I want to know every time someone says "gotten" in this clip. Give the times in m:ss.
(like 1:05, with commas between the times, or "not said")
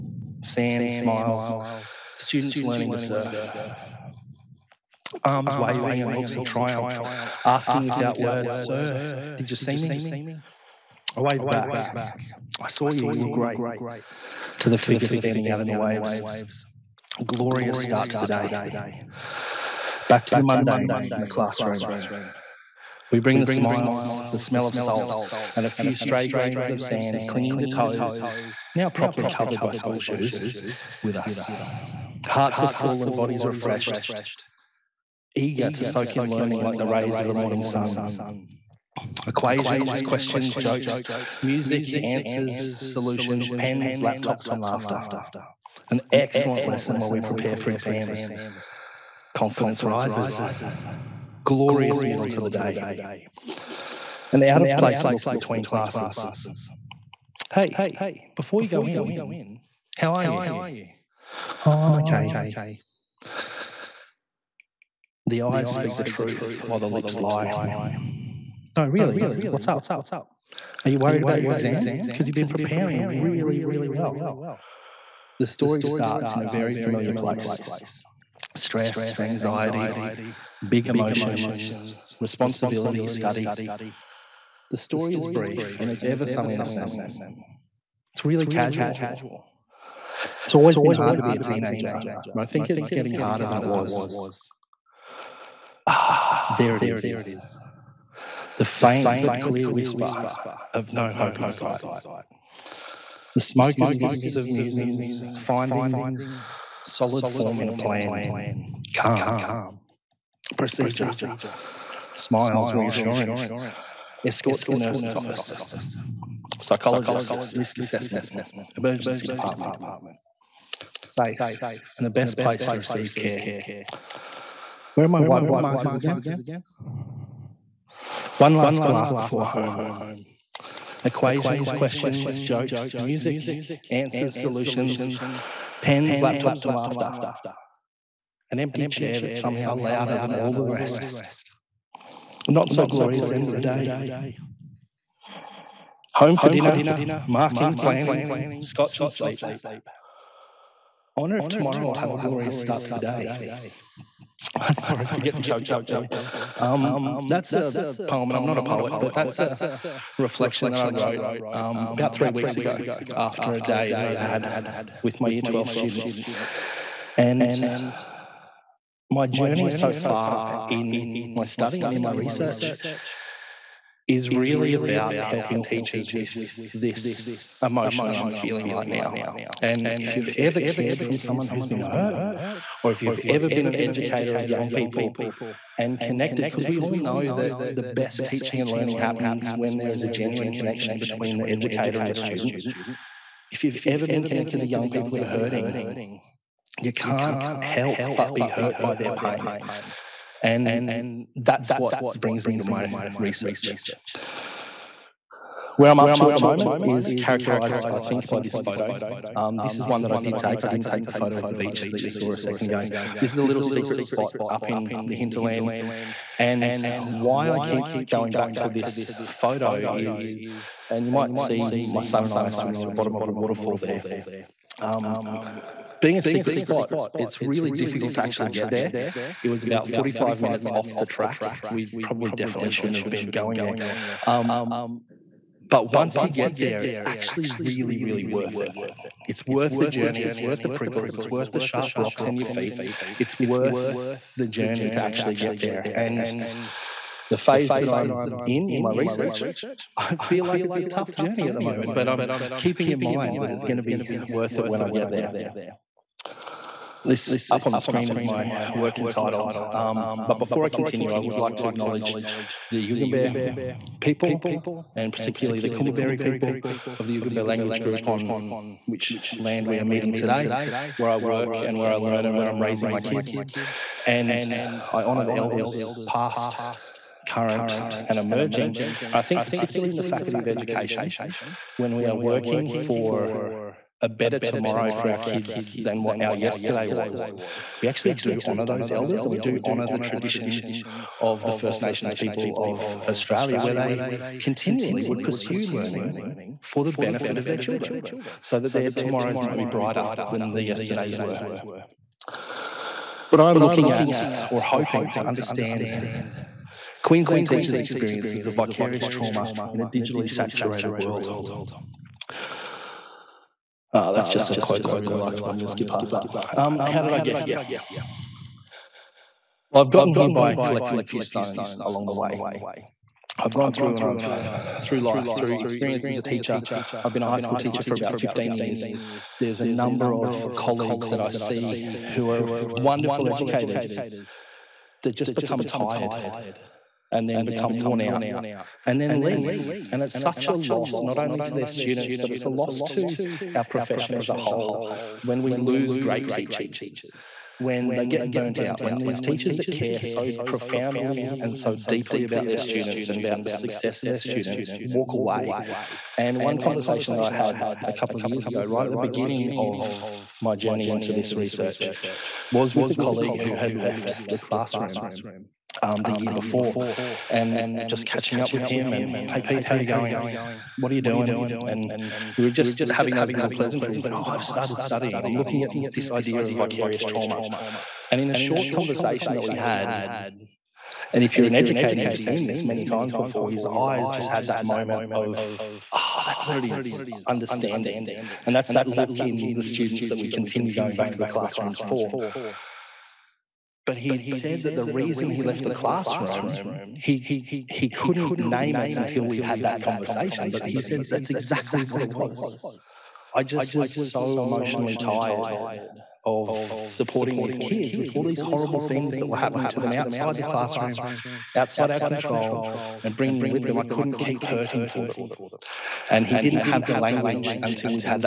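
5:19.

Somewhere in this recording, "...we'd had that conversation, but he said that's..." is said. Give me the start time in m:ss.
6:39.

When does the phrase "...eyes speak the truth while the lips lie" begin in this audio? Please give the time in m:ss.
1:05.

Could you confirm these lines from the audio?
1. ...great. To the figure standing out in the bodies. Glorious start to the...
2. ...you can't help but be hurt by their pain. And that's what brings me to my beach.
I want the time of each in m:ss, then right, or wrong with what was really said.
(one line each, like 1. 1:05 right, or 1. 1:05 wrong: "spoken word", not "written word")
1. 0:13 wrong: "waves", not "bodies"
2. 3:16 wrong: "research", not "beach".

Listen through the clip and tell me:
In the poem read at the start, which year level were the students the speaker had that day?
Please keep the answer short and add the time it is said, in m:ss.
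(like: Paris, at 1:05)
Year 12, at 2:45.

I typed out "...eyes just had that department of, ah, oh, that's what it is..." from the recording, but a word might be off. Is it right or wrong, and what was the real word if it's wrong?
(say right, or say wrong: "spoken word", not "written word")
wrong: "moment", not "department".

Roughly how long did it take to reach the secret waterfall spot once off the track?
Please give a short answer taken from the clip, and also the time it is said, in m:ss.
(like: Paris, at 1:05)
45 minutes, at 3:49.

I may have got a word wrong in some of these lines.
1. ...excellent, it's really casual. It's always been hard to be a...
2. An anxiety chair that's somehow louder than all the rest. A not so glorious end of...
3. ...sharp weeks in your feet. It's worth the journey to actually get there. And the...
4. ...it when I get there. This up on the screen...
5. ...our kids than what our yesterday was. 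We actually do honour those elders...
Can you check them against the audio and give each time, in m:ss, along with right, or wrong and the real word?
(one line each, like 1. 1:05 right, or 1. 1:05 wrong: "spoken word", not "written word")
1. 1:26 wrong: "innocent", not "excellent"
2. 2:18 wrong: "empty", not "anxiety"
3. 4:01 wrong: "rocks", not "weeks"
4. 4:14 right
5. 4:45 right.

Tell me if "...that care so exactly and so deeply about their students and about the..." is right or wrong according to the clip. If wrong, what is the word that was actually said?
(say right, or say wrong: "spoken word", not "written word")
wrong: "profoundly", not "exactly".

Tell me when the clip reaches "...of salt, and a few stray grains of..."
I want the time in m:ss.
0:24.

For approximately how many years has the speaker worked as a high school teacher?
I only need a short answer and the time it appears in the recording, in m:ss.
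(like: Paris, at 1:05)
15 years, at 5:27.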